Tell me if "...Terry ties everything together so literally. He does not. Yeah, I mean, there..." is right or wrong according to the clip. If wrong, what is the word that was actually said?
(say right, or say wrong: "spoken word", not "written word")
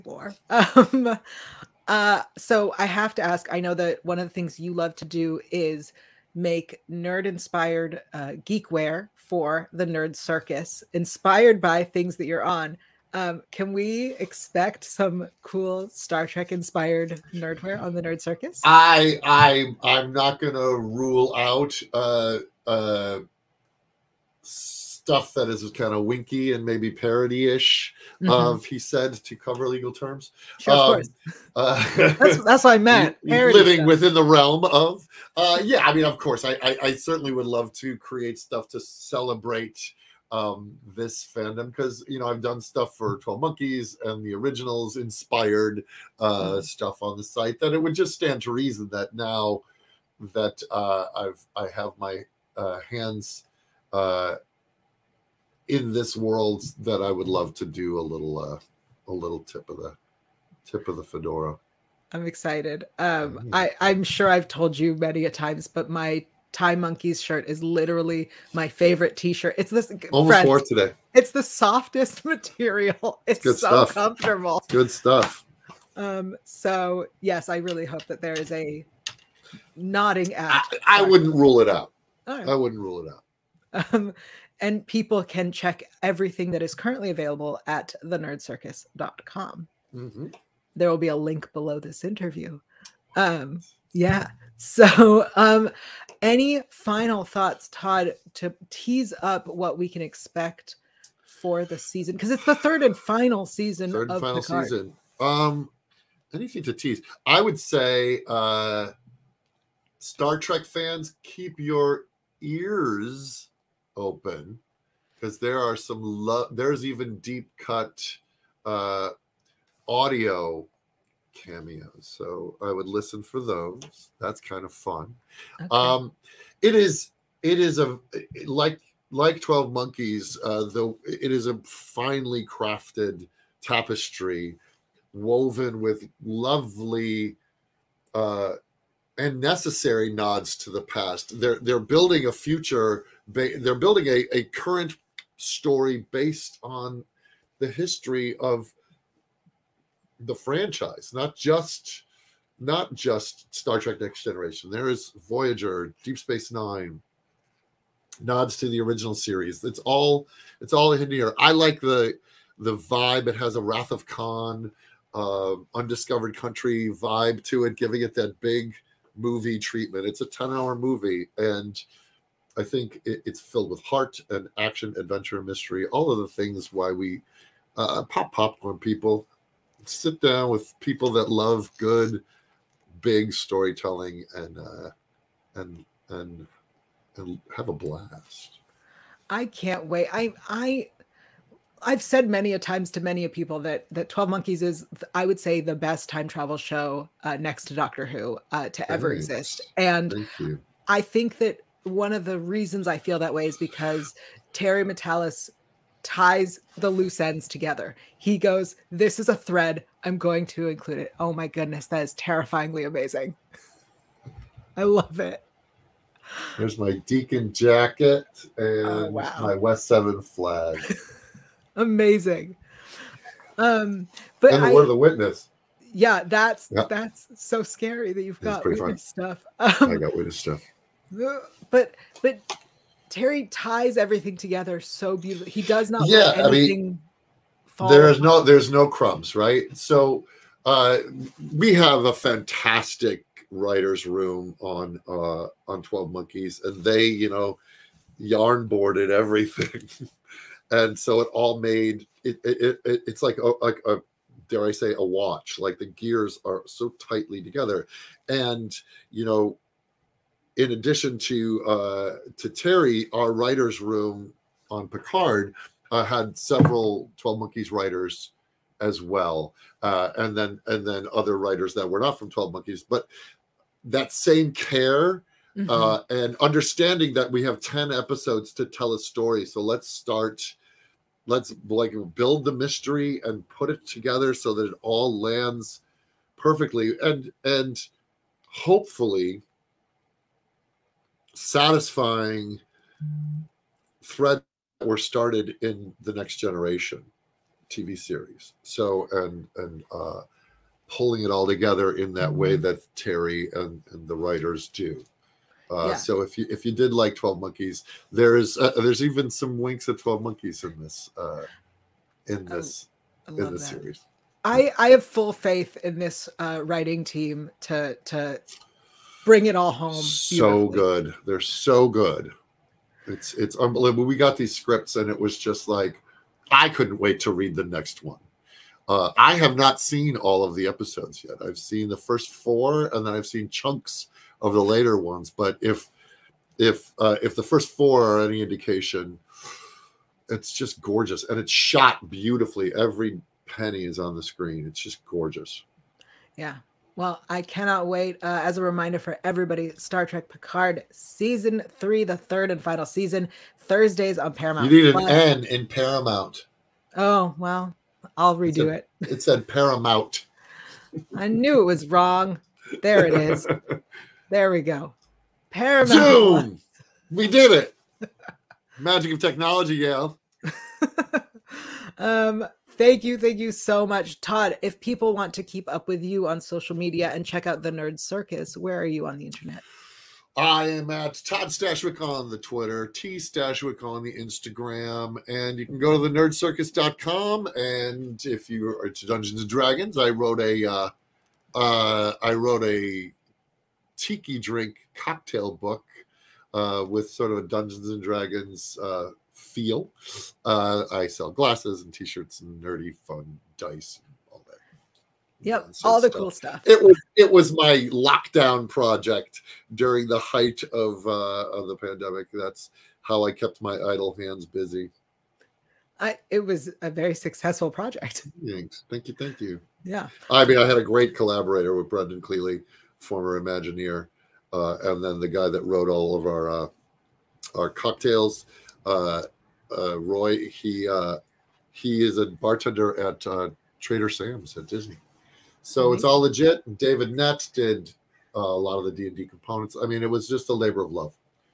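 wrong: "beautifully", not "literally".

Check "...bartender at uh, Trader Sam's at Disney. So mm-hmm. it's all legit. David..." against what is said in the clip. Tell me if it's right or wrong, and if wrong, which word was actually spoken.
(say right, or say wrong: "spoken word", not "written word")
right.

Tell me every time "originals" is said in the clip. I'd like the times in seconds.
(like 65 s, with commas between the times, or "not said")
44 s, 158 s.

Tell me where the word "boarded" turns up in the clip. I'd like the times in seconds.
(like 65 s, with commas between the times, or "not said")
248 s.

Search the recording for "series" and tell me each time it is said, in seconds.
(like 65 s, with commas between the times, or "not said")
159 s, 297 s, 313 s.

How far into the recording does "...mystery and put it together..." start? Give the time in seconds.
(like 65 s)
282 s.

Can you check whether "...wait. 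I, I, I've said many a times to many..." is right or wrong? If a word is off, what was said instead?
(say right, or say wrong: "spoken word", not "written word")
right.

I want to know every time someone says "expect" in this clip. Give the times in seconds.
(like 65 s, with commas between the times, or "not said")
14 s, 100 s.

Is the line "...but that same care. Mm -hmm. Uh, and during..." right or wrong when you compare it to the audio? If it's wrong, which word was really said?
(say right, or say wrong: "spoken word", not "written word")
wrong: "understanding", not "during".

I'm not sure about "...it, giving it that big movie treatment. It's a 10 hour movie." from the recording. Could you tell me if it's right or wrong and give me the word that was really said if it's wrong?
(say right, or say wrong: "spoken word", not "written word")
right.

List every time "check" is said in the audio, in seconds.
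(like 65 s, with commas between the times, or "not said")
85 s, 377 s.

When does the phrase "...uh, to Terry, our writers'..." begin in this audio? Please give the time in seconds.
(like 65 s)
261 s.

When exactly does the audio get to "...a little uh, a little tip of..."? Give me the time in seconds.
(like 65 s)
57 s.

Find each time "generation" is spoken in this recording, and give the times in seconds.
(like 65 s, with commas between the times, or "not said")
154 s, 296 s.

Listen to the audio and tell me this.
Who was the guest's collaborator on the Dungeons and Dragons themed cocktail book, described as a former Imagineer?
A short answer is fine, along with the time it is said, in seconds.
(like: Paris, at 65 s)
Brendan Cleely, at 421 s.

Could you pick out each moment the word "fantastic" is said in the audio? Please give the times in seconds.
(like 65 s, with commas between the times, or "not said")
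242 s.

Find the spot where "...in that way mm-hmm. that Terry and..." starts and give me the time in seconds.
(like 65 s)
301 s.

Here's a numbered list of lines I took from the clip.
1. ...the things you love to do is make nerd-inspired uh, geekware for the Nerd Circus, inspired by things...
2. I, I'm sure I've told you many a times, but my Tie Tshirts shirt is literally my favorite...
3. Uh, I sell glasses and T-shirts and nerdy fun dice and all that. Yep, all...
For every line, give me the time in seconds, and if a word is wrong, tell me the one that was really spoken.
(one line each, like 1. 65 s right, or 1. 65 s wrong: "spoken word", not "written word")
1. 4 s right
2. 63 s wrong: "Monkeys", not "Tshirts"
3. 400 s right.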